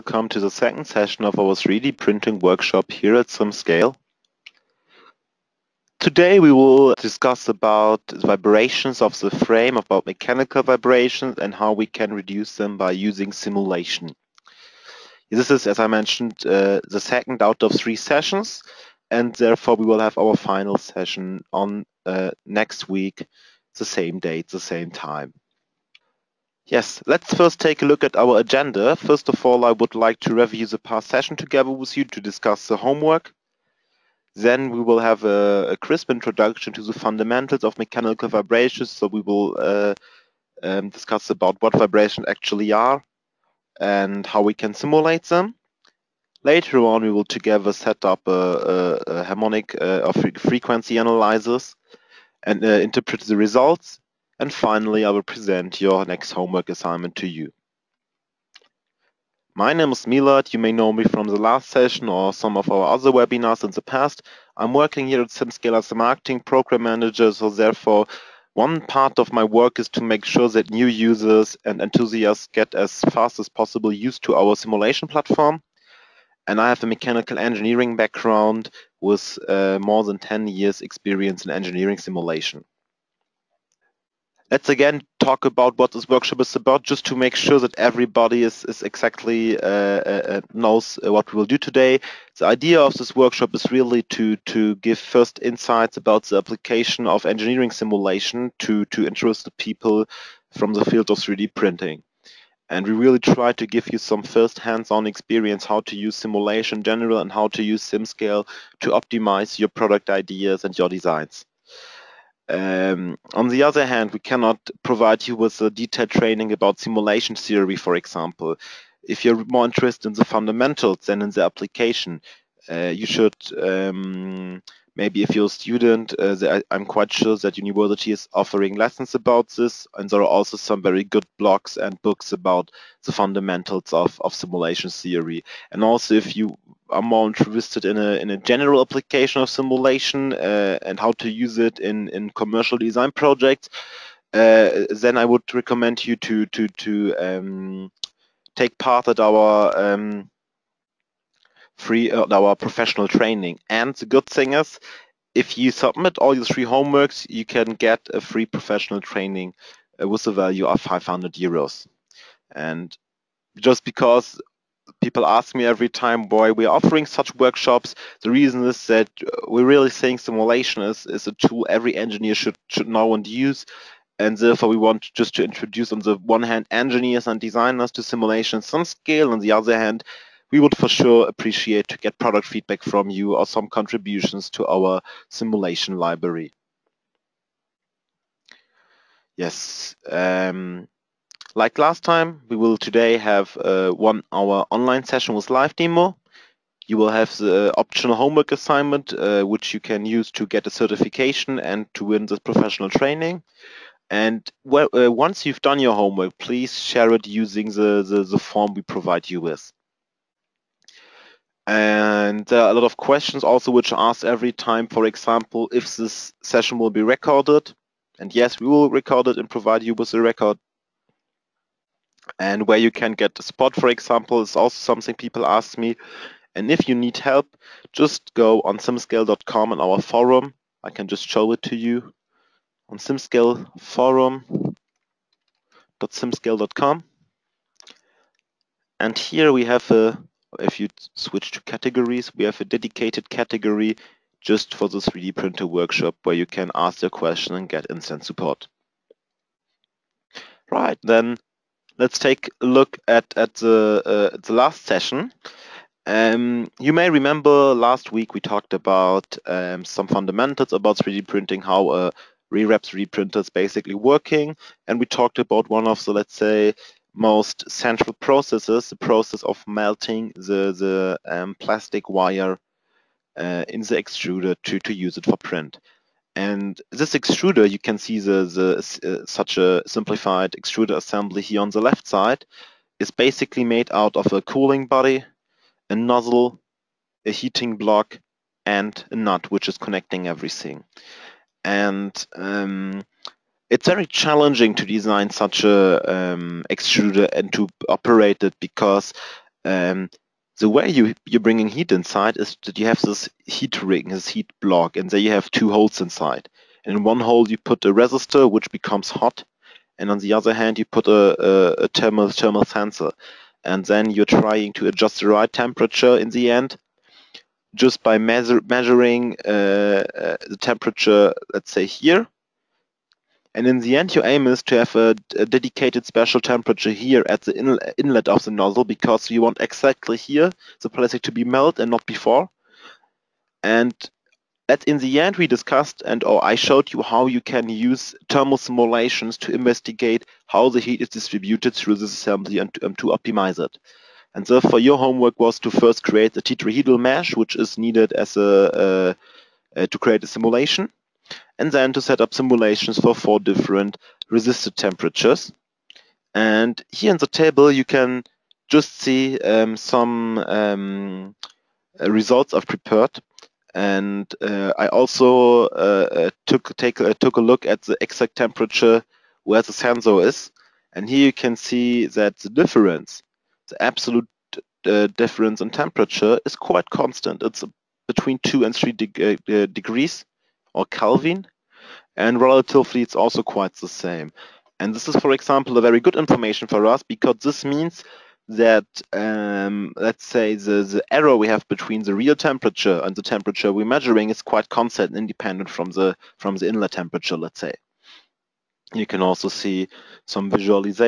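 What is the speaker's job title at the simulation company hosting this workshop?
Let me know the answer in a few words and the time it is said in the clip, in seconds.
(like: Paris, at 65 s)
marketing program manager, at 65 s.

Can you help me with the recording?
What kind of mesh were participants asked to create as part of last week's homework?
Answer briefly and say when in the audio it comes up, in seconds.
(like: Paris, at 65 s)
tetrahedral mesh, at 346 s.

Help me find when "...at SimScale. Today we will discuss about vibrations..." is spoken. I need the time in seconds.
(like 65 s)
3 s.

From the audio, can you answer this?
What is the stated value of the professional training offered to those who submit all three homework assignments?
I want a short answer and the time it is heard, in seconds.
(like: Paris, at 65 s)
500 euros, at 160 s.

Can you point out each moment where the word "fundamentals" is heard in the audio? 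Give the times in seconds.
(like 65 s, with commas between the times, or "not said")
36 s, 120 s, 133 s, 260 s.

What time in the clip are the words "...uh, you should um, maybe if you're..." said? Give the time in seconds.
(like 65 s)
122 s.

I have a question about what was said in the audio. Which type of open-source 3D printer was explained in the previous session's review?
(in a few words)
RepRap.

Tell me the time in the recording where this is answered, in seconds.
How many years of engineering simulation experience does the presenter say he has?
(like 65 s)
79 s.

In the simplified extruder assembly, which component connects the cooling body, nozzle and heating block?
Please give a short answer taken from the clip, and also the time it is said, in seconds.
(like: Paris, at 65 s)
a nut, at 289 s.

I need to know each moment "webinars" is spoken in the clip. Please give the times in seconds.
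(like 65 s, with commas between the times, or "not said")
63 s.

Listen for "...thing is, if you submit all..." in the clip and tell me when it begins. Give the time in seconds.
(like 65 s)
154 s.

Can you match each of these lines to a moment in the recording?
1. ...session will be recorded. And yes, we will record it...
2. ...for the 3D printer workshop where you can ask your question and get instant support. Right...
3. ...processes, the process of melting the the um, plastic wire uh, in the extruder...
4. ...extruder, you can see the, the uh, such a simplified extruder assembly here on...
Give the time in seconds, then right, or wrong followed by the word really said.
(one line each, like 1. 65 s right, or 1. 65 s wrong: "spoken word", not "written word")
1. 216 s right
2. 244 s right
3. 268 s right
4. 277 s right.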